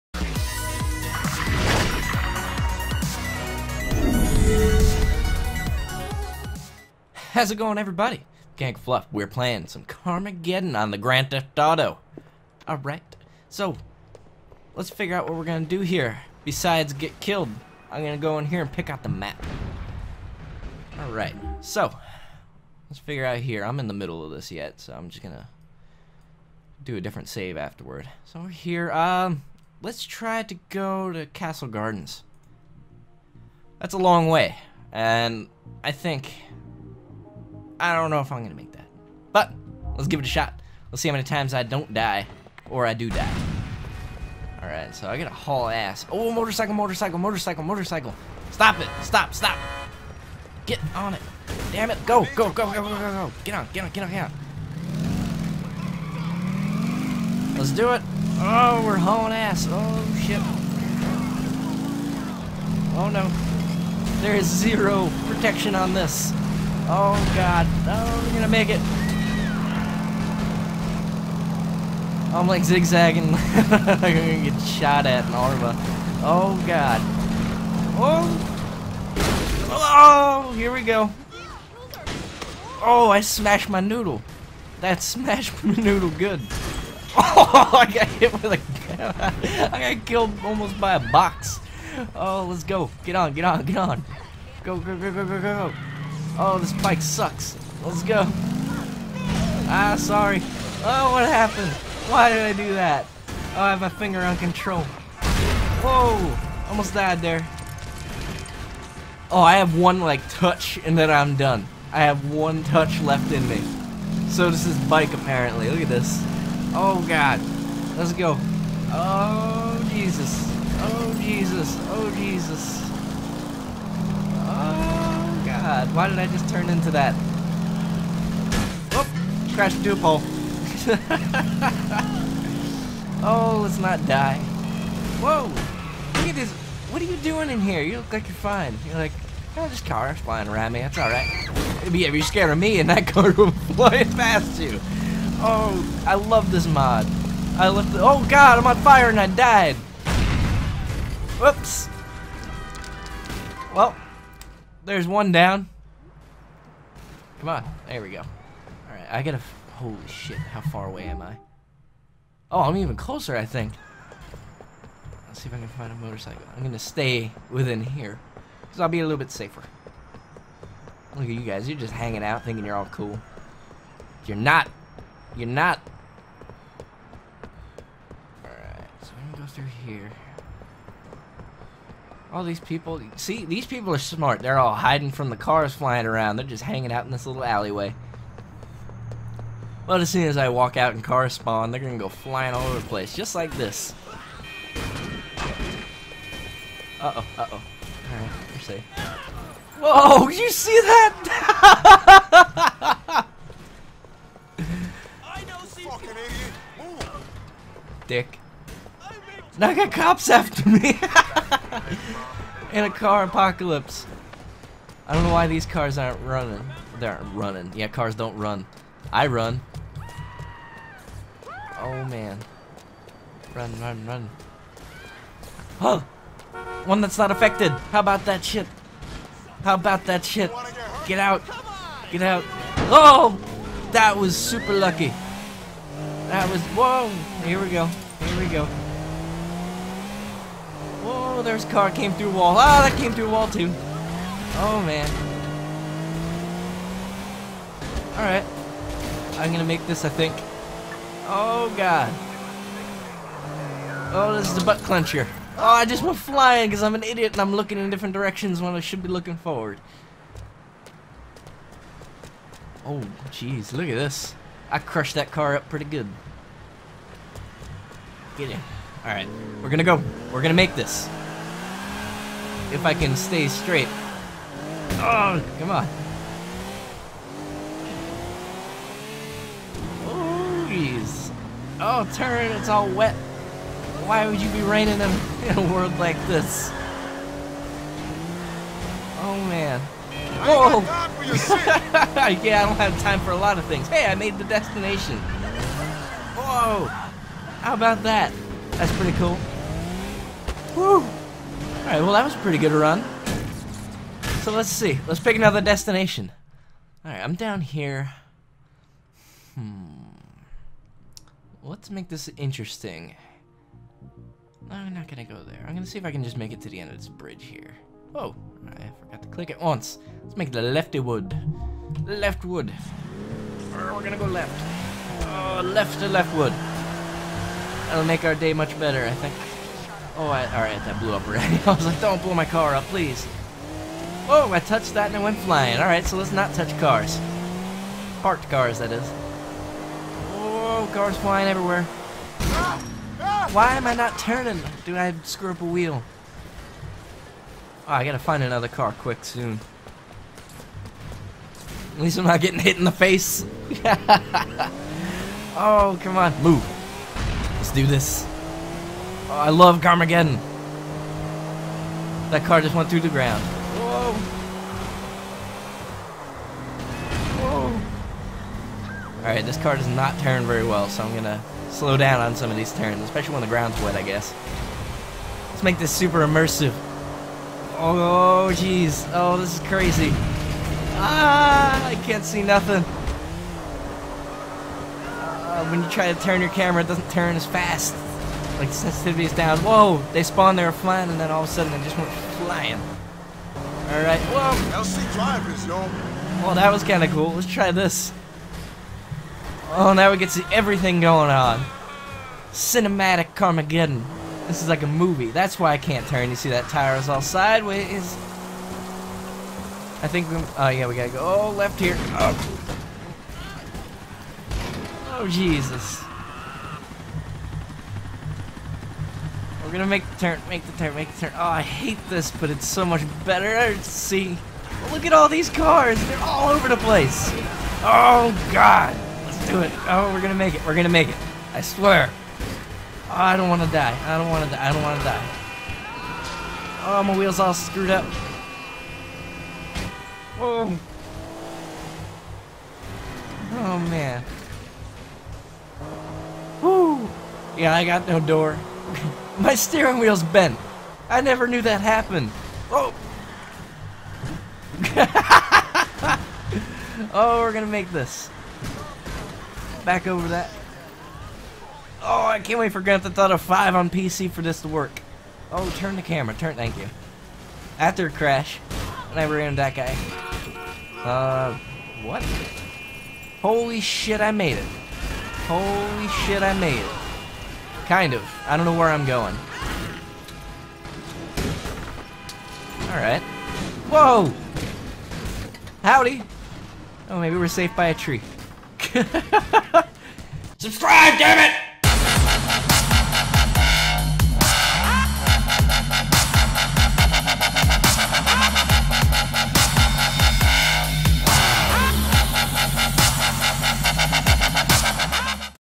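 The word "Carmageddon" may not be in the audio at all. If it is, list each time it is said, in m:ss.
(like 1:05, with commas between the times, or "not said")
0:09, 5:59, 6:43.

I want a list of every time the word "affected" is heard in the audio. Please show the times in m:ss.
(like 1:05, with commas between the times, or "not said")
3:47.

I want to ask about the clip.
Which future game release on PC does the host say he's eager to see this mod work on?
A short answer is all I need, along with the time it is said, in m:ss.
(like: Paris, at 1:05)
Grand Theft Auto 5, at 7:42.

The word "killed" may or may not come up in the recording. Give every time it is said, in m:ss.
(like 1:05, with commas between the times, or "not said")
0:17, 1:30.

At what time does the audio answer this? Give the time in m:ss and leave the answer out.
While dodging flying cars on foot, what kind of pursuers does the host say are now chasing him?
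3:29.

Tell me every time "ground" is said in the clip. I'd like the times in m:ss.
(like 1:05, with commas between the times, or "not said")
6:03, 6:13.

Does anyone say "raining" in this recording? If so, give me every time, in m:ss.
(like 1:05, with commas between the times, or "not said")
4:44.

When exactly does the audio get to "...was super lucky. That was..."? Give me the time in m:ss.
3:54.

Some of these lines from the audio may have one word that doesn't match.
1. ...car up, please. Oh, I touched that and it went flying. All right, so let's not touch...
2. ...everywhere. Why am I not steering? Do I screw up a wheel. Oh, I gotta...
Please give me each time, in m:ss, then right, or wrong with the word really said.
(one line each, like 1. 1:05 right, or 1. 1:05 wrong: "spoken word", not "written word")
1. 5:32 right
2. 5:41 wrong: "turning", not "steering".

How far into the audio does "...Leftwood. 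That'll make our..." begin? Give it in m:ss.
5:26.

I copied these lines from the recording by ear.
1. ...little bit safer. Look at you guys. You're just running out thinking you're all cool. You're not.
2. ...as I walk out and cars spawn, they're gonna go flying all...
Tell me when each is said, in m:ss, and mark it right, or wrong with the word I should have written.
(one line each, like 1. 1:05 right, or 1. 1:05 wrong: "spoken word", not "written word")
1. 2:49 wrong: "hanging", not "running"
2. 3:10 right.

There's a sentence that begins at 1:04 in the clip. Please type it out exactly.
There is zero protection on this.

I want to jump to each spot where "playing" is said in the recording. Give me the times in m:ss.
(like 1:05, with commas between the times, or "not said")
0:09.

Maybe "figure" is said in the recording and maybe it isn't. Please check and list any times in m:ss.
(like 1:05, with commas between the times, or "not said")
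0:14, 0:22.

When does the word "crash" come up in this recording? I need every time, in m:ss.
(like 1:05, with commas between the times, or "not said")
2:09, 7:48.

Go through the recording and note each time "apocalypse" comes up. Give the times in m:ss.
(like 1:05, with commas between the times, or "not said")
3:33.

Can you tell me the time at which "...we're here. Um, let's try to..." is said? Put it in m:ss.
0:28.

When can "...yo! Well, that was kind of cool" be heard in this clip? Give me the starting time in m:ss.
6:35.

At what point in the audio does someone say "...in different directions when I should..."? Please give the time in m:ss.
4:17.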